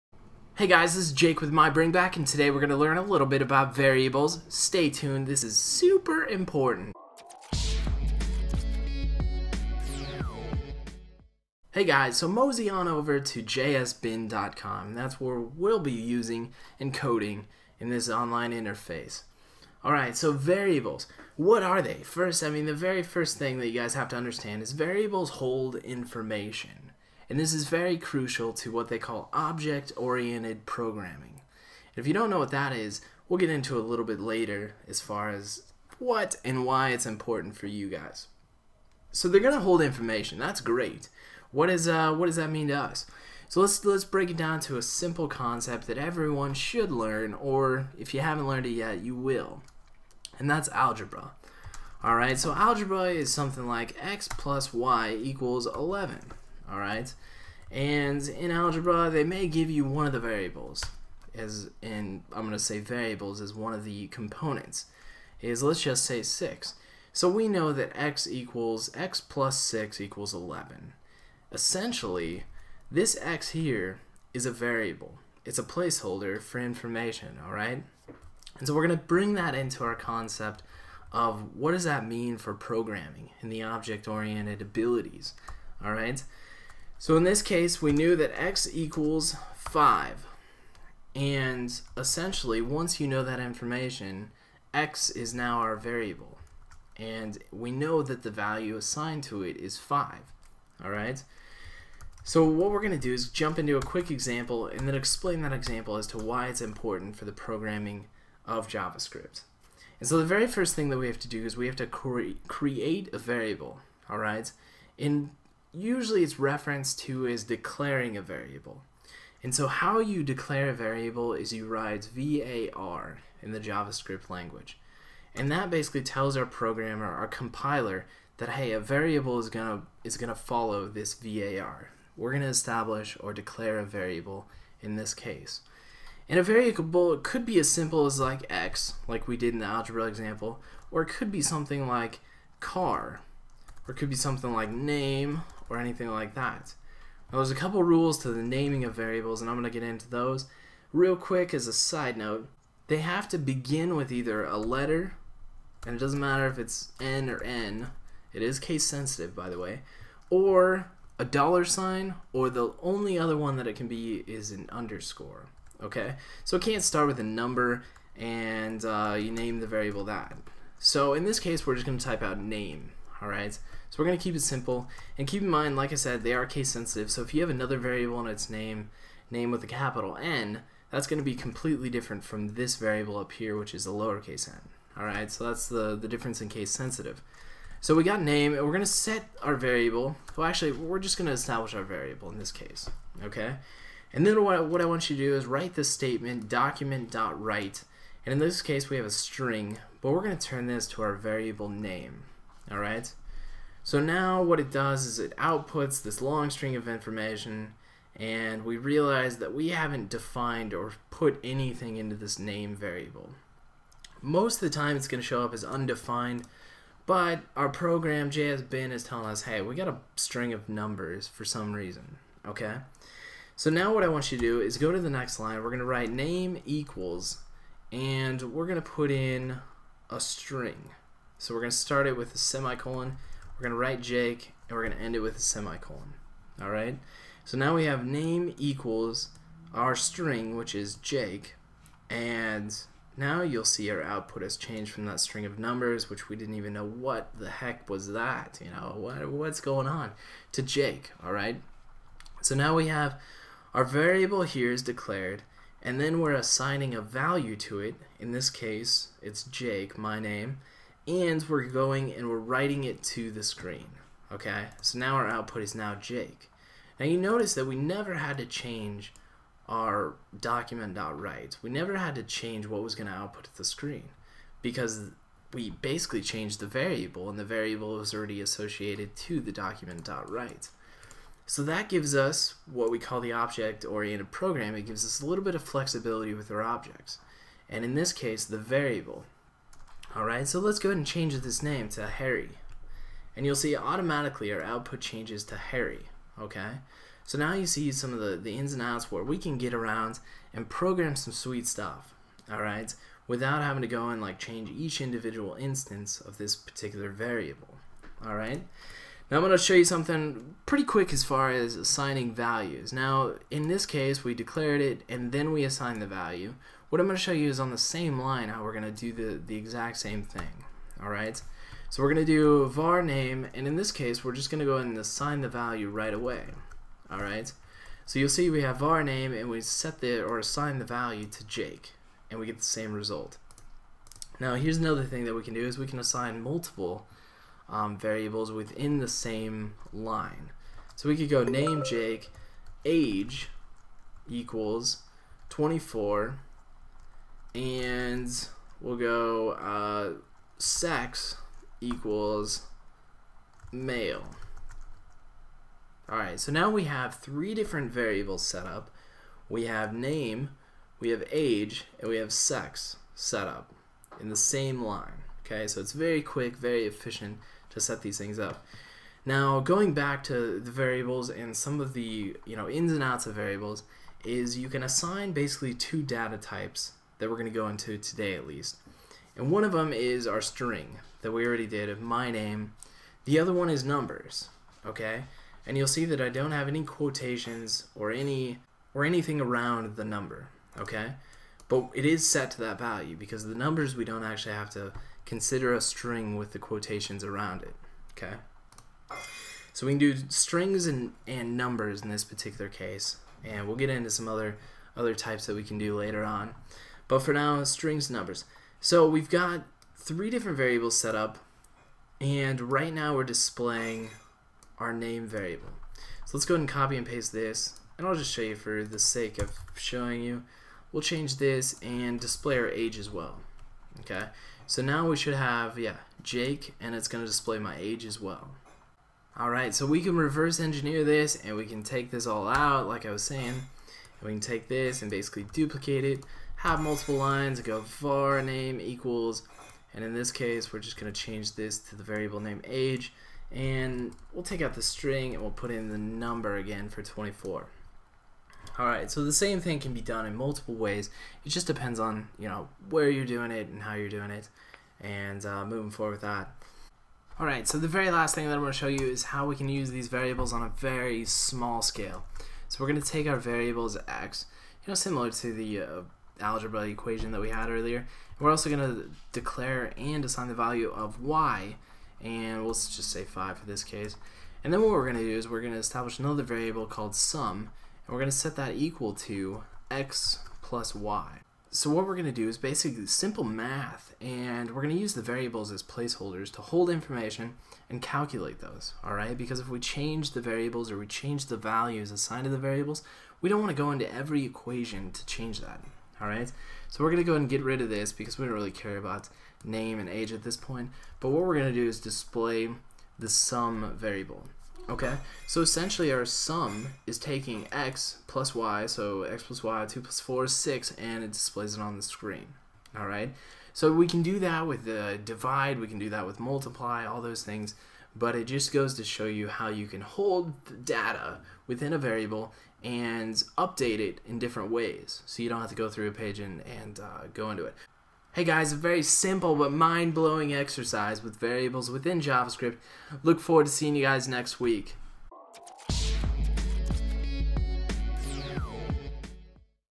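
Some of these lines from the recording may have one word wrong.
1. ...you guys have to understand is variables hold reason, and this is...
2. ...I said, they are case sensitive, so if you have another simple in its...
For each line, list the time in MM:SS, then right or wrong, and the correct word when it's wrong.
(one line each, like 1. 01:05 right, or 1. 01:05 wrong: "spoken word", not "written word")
1. 00:23 wrong: "information", not "reason"
2. 02:55 wrong: "variable", not "simple".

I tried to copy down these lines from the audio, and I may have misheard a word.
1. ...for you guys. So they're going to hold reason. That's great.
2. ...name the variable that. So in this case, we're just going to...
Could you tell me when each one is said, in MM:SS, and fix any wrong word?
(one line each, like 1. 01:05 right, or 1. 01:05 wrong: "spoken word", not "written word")
1. 00:37 wrong: "information", not "reason"
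2. 02:49 right.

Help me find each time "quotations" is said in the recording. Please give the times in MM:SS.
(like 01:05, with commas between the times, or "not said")
06:26, 06:36.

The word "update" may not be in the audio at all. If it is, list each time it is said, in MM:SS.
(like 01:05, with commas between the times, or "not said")
08:43.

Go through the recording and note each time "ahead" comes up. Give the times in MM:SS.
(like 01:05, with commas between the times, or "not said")
04:50, 06:56, 08:17.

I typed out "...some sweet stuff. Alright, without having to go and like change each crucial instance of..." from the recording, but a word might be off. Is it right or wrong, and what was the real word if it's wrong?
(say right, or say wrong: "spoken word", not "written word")
wrong: "individual", not "crucial".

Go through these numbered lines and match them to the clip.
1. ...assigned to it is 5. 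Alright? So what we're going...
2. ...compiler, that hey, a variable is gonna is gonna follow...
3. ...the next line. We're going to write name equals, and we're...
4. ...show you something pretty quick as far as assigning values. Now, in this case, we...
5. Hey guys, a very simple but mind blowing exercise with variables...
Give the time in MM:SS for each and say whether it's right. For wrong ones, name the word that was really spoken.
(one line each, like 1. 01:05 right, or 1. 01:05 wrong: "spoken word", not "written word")
1. 01:38 right
2. 02:07 right
3. 03:44 right
4. 05:09 right
5. 08:48 right.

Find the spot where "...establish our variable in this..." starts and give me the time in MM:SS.
03:11.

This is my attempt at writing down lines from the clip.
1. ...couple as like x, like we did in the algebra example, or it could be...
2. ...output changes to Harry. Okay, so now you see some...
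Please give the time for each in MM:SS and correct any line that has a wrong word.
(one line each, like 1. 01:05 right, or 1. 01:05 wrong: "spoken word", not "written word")
1. 02:17 wrong: "simple", not "couple"
2. 04:54 right.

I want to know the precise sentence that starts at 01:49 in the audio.
And so the very first thing that we have to do is we have to cre create a variable.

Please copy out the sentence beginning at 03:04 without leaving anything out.
Alright, so that's the, the difference in case sensitive.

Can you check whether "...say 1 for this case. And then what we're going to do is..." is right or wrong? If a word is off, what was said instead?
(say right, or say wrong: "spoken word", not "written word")
wrong: "5", not "1".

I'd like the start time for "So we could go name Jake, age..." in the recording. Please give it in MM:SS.
05:40.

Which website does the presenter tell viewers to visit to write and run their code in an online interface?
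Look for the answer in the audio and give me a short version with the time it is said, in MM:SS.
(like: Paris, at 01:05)
jsbin.com, at 00:13.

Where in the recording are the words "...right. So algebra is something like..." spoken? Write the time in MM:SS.
00:52.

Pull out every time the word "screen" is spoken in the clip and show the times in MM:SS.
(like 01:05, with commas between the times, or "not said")
04:23, 04:33, 08:32.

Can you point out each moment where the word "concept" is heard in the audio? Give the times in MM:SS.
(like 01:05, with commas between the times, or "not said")
00:45, 01:19.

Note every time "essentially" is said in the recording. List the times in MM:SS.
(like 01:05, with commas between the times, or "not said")
01:11, 01:31, 08:25.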